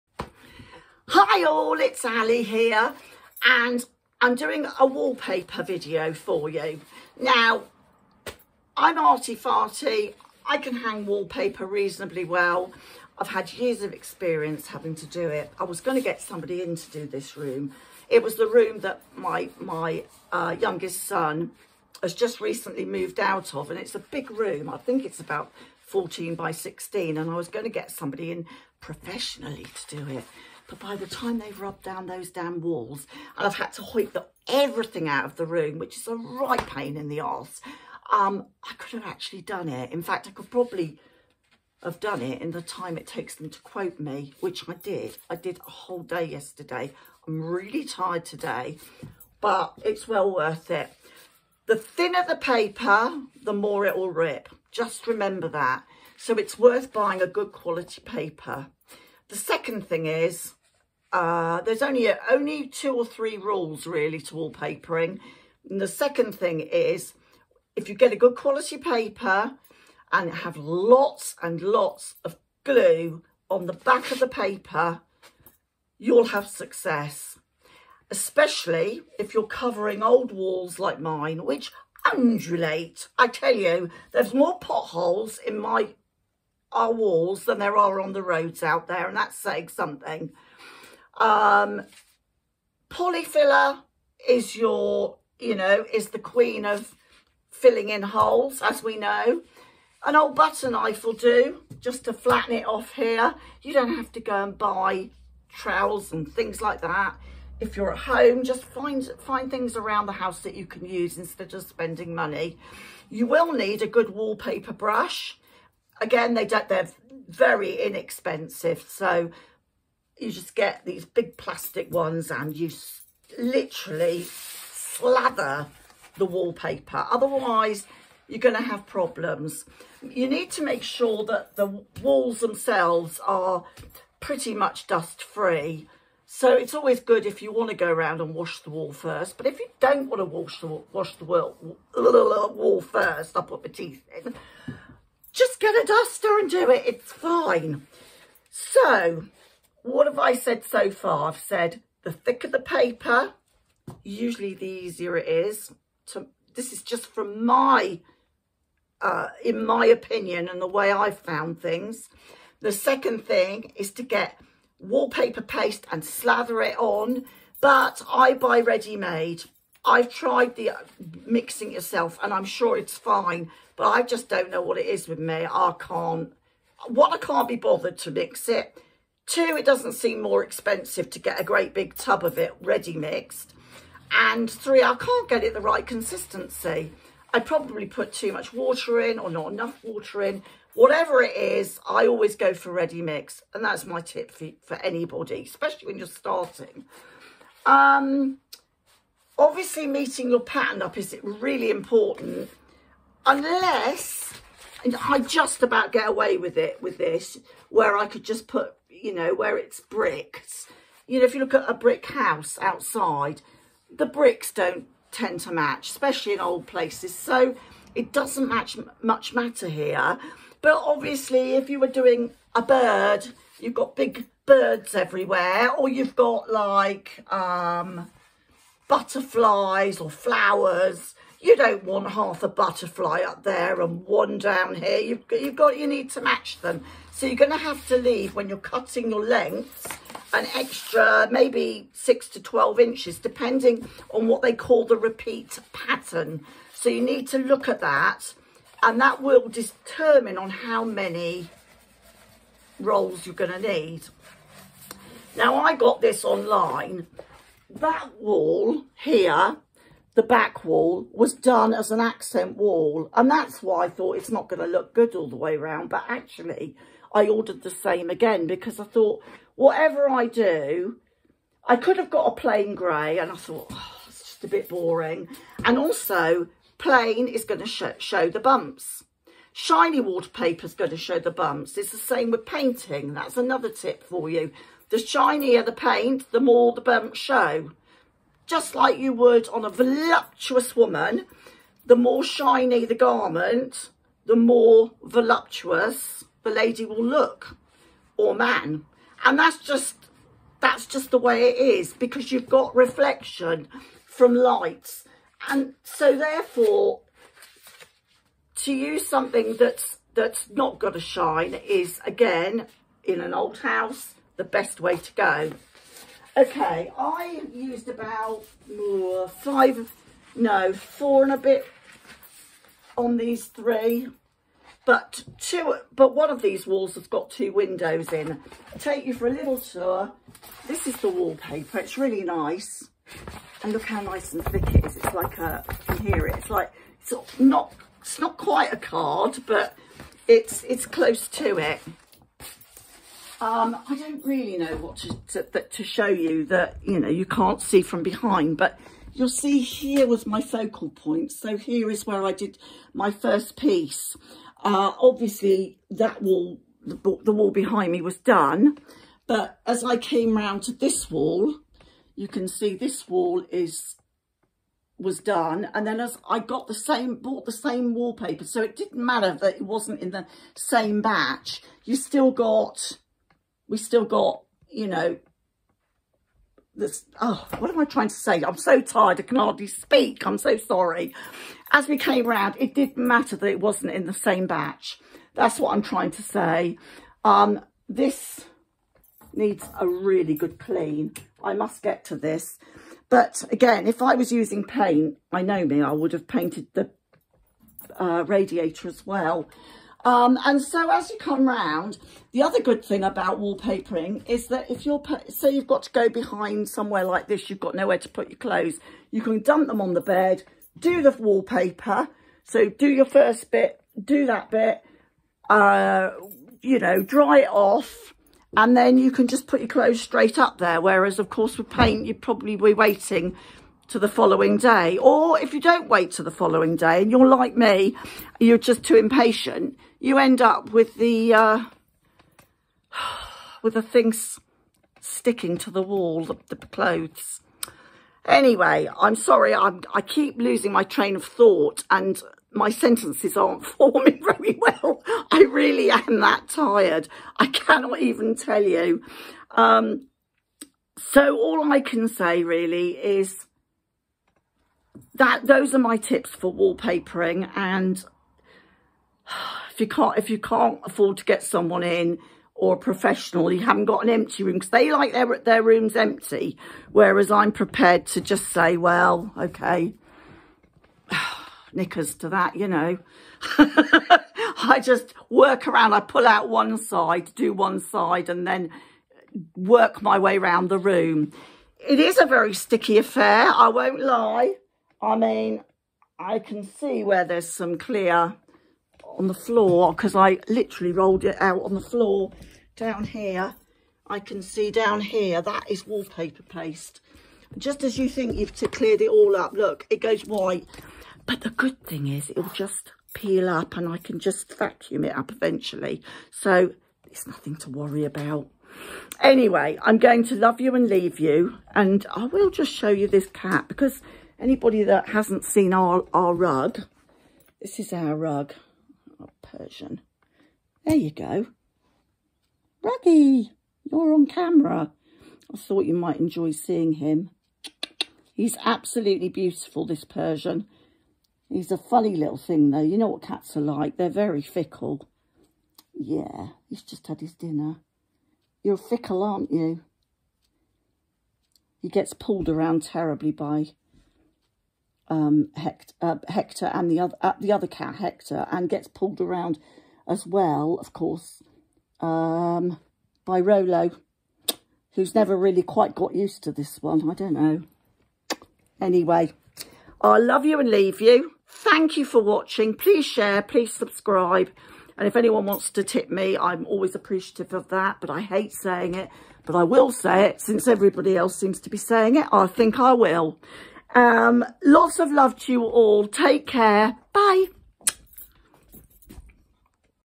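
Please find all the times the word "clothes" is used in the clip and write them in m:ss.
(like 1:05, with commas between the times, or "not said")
6:48, 6:59, 7:16.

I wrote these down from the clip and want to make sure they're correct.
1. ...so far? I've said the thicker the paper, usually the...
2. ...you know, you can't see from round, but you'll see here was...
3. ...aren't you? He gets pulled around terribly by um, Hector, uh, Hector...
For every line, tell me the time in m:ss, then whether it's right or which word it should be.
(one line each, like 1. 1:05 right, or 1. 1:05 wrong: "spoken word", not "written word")
1. 2:30 right
2. 5:46 wrong: "behind", not "round"
3. 8:59 right.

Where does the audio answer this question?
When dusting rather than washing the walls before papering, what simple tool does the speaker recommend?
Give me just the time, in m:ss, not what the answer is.
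2:25.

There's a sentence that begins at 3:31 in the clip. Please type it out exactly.
You know, if you look at a brick house outside, the bricks don't tend to match, especially in old places.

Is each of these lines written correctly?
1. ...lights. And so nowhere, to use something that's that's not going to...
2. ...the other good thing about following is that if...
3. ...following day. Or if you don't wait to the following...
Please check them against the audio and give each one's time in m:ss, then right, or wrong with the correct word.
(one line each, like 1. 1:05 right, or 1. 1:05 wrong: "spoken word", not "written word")
1. 5:04 wrong: "therefore", not "nowhere"
2. 6:42 wrong: "wallpapering", not "following"
3. 7:04 right.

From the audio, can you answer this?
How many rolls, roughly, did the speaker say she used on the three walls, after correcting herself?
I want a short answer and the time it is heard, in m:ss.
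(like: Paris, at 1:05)
4 and a bit, at 5:20.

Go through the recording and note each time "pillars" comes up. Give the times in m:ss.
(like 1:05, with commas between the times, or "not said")
not said.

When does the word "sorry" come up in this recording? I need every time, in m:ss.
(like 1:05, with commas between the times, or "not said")
6:20, 7:19.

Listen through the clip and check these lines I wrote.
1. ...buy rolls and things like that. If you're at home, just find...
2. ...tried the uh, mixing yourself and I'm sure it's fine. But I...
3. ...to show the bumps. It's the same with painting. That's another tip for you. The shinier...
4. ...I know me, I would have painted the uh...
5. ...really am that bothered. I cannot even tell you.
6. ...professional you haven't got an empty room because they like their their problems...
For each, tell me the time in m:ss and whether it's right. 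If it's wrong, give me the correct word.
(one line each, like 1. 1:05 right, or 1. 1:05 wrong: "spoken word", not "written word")
1. 1:44 wrong: "trowels", not "rolls"
2. 2:50 right
3. 4:40 right
4. 6:35 right
5. 7:25 wrong: "tired", not "bothered"
6. 7:42 wrong: "rooms", not "problems".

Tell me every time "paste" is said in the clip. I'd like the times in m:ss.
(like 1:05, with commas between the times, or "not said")
2:45, 8:16.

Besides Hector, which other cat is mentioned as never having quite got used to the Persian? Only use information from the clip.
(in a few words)
Rolo.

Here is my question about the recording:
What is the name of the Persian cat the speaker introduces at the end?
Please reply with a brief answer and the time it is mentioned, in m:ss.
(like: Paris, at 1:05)
Ruggy, at 8:42.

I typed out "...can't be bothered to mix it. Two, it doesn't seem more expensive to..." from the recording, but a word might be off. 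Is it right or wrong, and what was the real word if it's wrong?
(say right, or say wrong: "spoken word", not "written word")
right.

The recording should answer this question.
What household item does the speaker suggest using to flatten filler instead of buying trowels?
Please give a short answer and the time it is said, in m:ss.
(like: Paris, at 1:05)
An old butter knife, at 1:40.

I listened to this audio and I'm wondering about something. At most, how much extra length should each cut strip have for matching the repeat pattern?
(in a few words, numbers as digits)
12 inches.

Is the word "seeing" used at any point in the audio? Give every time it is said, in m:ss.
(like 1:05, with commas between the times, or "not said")
8:46.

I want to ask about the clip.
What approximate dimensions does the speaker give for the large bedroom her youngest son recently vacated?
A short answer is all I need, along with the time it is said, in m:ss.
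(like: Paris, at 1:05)
14 by 16, at 0:25.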